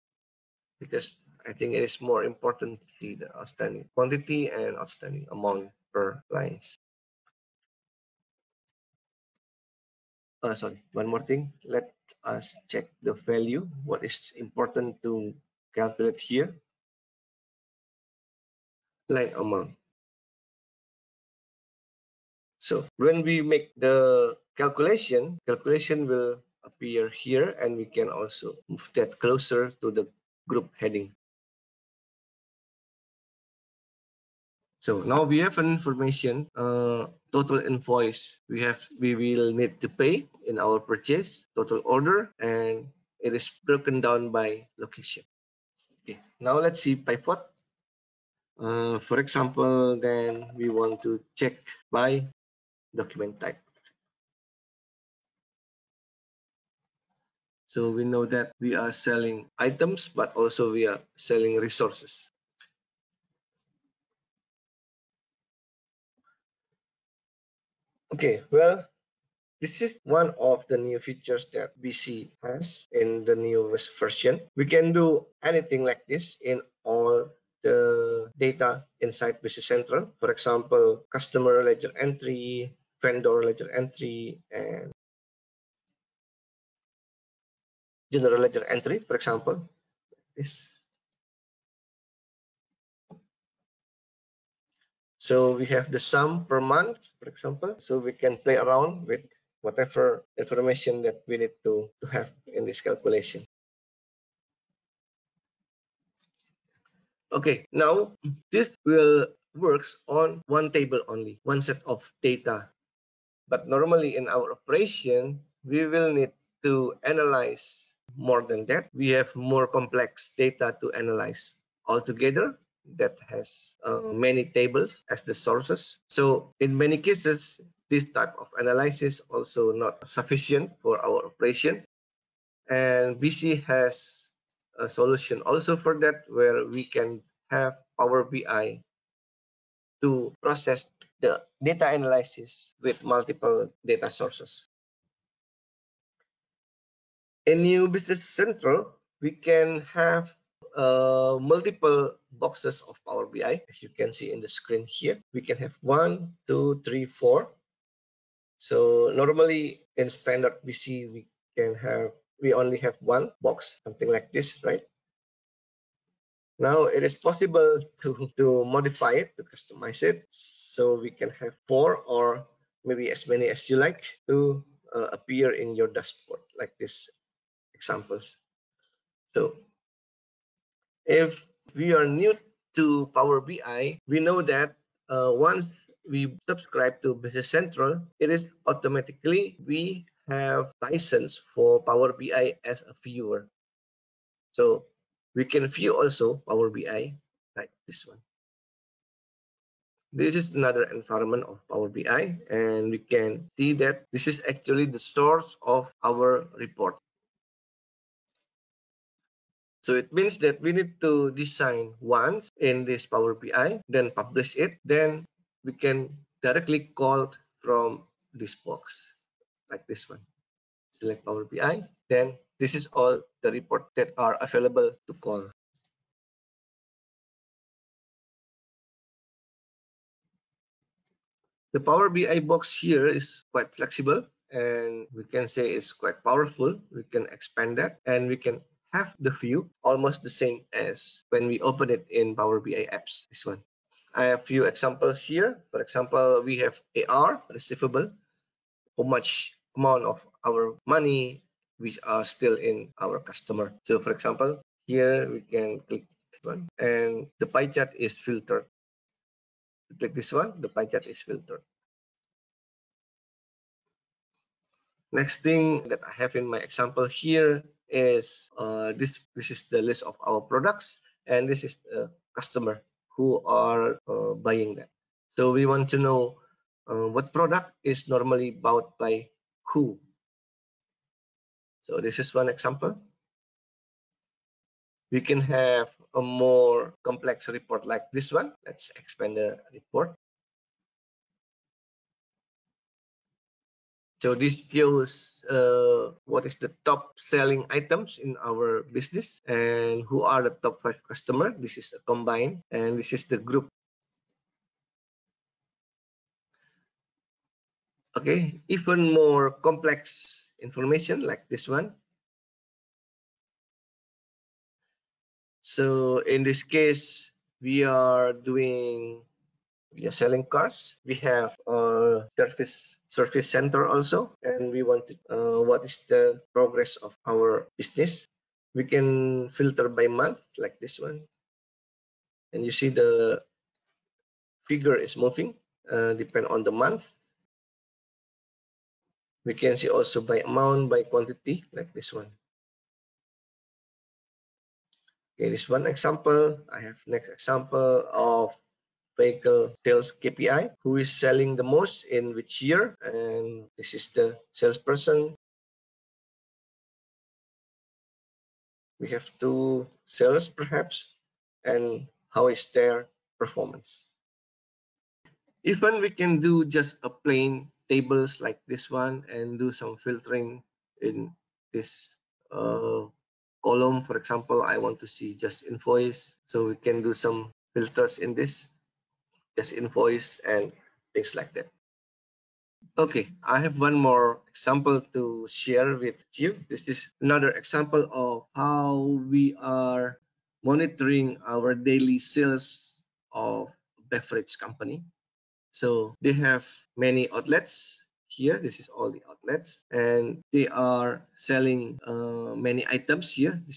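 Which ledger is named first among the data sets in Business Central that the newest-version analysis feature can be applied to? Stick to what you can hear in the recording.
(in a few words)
Customer ledger entry.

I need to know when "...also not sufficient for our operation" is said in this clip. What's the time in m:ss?
2:09.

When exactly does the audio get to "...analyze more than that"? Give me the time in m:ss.
1:57.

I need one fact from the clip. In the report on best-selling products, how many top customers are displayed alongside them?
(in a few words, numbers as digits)
Five.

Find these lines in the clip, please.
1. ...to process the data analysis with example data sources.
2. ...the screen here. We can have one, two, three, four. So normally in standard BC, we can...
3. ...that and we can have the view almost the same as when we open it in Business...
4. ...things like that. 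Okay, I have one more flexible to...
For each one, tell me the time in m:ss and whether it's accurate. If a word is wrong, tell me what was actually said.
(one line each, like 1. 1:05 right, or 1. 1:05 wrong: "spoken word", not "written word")
1. 2:20 wrong: "multiple", not "example"
2. 2:34 right
3. 3:57 wrong: "Power", not "Business"
4. 6:21 wrong: "example", not "flexible".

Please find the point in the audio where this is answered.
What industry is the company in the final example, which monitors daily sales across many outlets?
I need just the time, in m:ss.
6:34.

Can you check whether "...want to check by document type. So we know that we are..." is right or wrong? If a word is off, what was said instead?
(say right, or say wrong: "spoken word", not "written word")
right.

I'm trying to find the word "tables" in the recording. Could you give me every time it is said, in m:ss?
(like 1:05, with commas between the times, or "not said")
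1:50, 2:04, 6:07.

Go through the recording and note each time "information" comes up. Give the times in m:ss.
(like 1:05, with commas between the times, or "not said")
0:35, 1:40, 5:10.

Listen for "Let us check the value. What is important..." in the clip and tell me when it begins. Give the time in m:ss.
0:11.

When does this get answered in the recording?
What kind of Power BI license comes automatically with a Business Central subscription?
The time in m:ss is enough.
3:13.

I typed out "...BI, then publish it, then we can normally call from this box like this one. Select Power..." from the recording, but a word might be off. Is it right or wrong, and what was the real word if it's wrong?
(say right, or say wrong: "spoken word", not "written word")
wrong: "directly", not "normally".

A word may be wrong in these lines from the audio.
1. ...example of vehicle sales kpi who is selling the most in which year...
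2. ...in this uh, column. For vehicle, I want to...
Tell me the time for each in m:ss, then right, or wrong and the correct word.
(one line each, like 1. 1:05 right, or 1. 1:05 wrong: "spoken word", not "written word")
1. 5:47 right
2. 6:11 wrong: "example", not "vehicle".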